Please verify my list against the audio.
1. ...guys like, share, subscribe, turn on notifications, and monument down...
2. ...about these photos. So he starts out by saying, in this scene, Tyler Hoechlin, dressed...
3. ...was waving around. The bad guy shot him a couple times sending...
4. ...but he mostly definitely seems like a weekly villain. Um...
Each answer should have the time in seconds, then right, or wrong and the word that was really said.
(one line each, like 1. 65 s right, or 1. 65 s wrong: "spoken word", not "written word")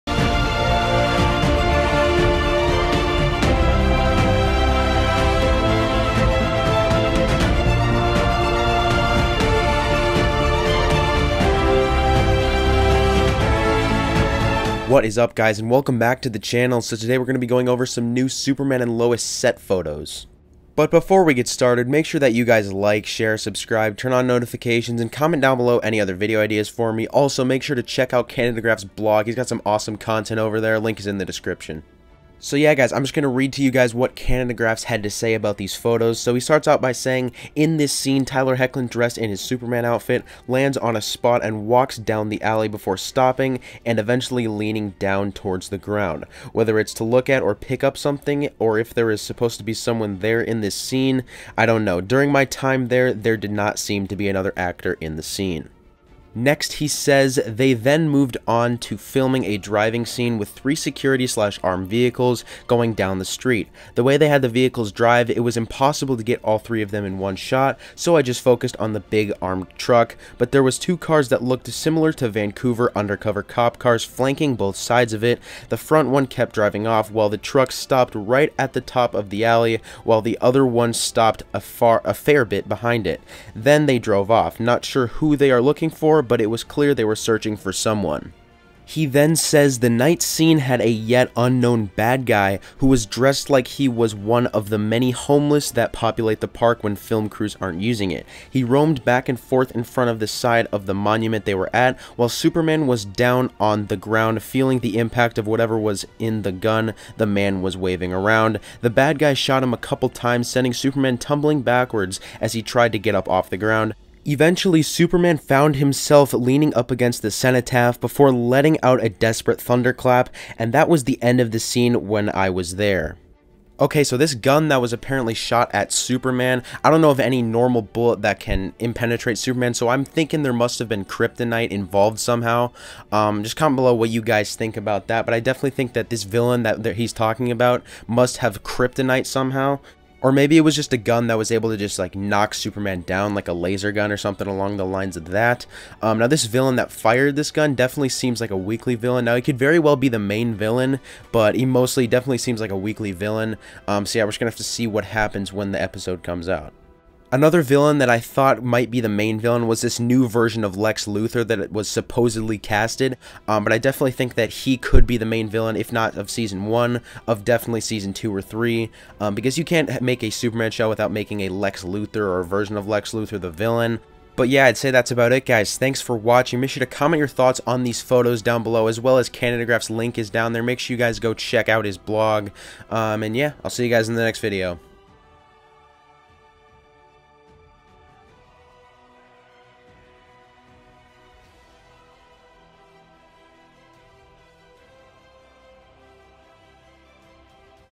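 1. 22 s wrong: "comment", not "monument"
2. 35 s right
3. 107 s right
4. 151 s right.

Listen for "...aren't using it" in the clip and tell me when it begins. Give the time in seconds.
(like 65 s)
97 s.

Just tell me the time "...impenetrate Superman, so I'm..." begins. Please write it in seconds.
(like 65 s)
128 s.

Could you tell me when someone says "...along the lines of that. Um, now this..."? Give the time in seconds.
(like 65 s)
144 s.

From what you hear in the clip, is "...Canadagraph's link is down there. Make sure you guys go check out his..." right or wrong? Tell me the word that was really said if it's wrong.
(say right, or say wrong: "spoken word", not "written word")
right.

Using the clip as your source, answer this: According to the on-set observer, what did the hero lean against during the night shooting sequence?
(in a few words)
the cenotaph.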